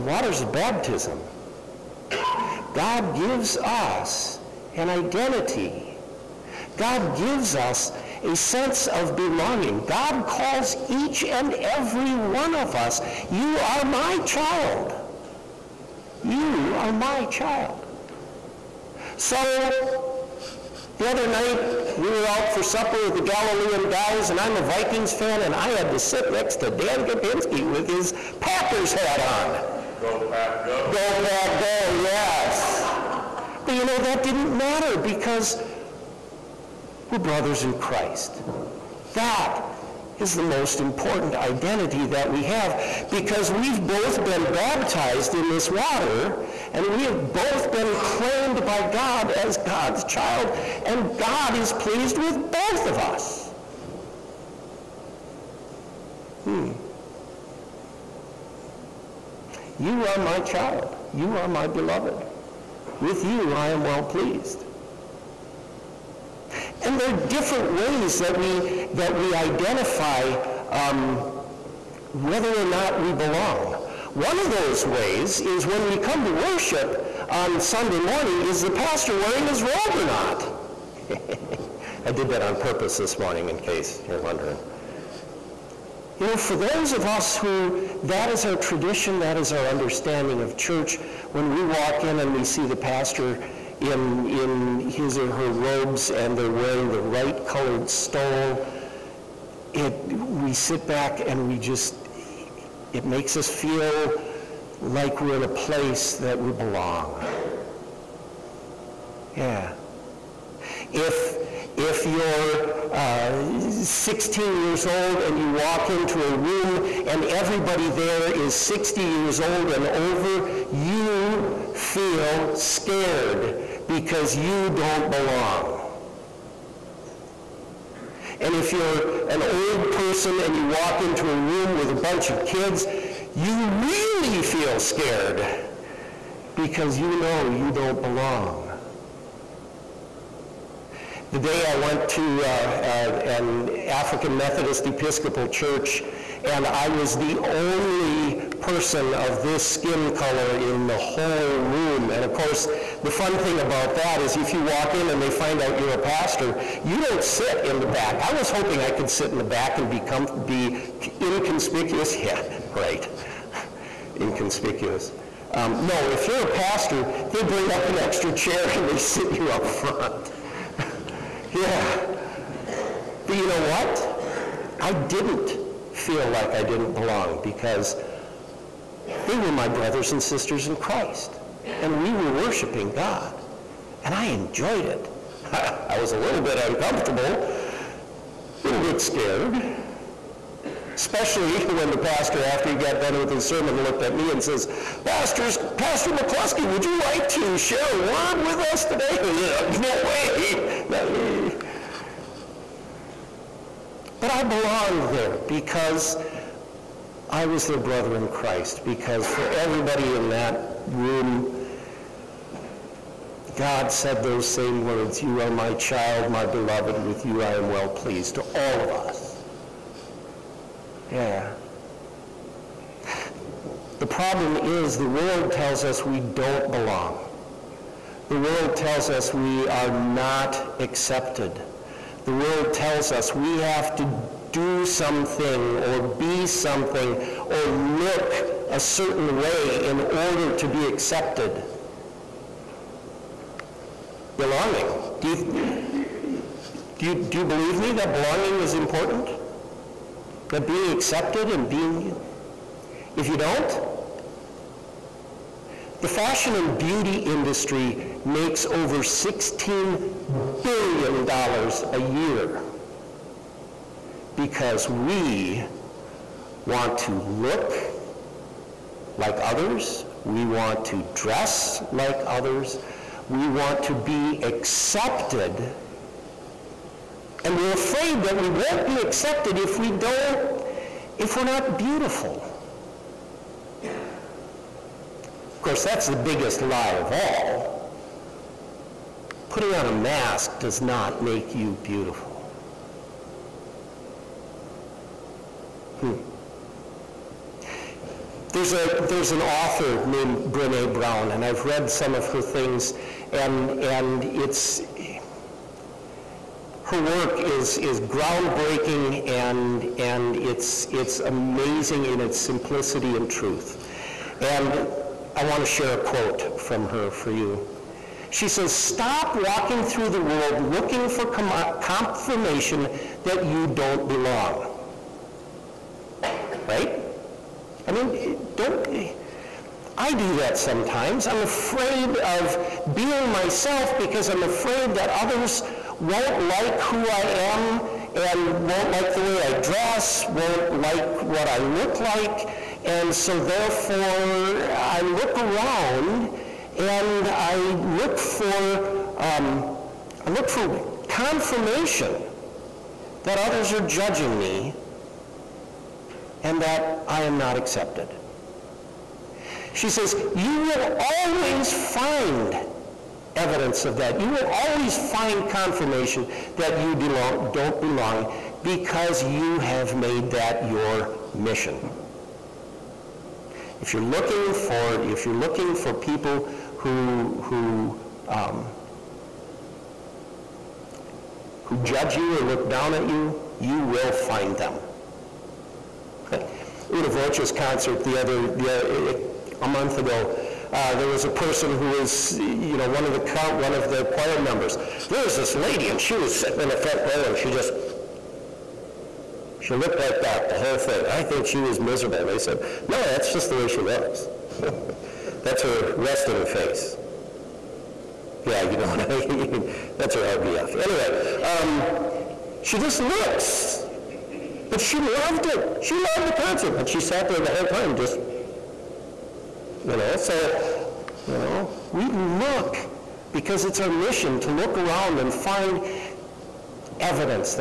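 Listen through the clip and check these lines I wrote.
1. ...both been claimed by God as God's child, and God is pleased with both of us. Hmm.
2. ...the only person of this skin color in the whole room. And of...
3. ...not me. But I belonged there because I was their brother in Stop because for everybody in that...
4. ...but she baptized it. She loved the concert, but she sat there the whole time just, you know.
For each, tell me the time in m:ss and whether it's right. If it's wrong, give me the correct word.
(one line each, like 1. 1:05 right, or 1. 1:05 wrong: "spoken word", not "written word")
1. 0:47 right
2. 2:27 right
3. 3:20 wrong: "Christ", not "Stop"
4. 6:54 wrong: "loved", not "baptized".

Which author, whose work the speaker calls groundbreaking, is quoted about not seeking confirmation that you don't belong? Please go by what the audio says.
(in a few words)
Brene Brown.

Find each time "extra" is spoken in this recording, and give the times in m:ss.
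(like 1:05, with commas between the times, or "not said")
2:47.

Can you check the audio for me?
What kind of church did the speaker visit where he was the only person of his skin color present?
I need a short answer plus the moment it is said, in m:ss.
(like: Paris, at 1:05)
African Methodist Episcopal, at 2:23.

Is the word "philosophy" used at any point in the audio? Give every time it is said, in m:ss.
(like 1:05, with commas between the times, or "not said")
not said.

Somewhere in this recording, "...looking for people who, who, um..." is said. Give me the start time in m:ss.
6:15.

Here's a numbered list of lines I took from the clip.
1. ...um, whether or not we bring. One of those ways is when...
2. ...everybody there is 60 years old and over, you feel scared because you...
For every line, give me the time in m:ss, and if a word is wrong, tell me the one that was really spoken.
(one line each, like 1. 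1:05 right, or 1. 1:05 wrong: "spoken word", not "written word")
1. 1:10 wrong: "belong", not "bring"
2. 1:57 right.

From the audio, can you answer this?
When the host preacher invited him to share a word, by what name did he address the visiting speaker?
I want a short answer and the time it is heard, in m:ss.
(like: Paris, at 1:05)
Pastor McCluskey, at 3:15.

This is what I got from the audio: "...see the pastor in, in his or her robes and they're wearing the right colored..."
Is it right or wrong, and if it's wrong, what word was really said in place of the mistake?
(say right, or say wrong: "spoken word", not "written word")
right.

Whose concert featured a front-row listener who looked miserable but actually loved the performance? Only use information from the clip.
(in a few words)
Una Voce.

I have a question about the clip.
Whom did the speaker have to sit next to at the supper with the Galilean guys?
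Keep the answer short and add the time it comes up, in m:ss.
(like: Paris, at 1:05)
Dan Kopinski, at 0:26.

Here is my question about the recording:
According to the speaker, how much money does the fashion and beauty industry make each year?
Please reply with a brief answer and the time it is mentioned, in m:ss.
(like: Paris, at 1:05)
$16 billion, at 4:19.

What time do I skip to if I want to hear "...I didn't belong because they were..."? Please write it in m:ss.
2:56.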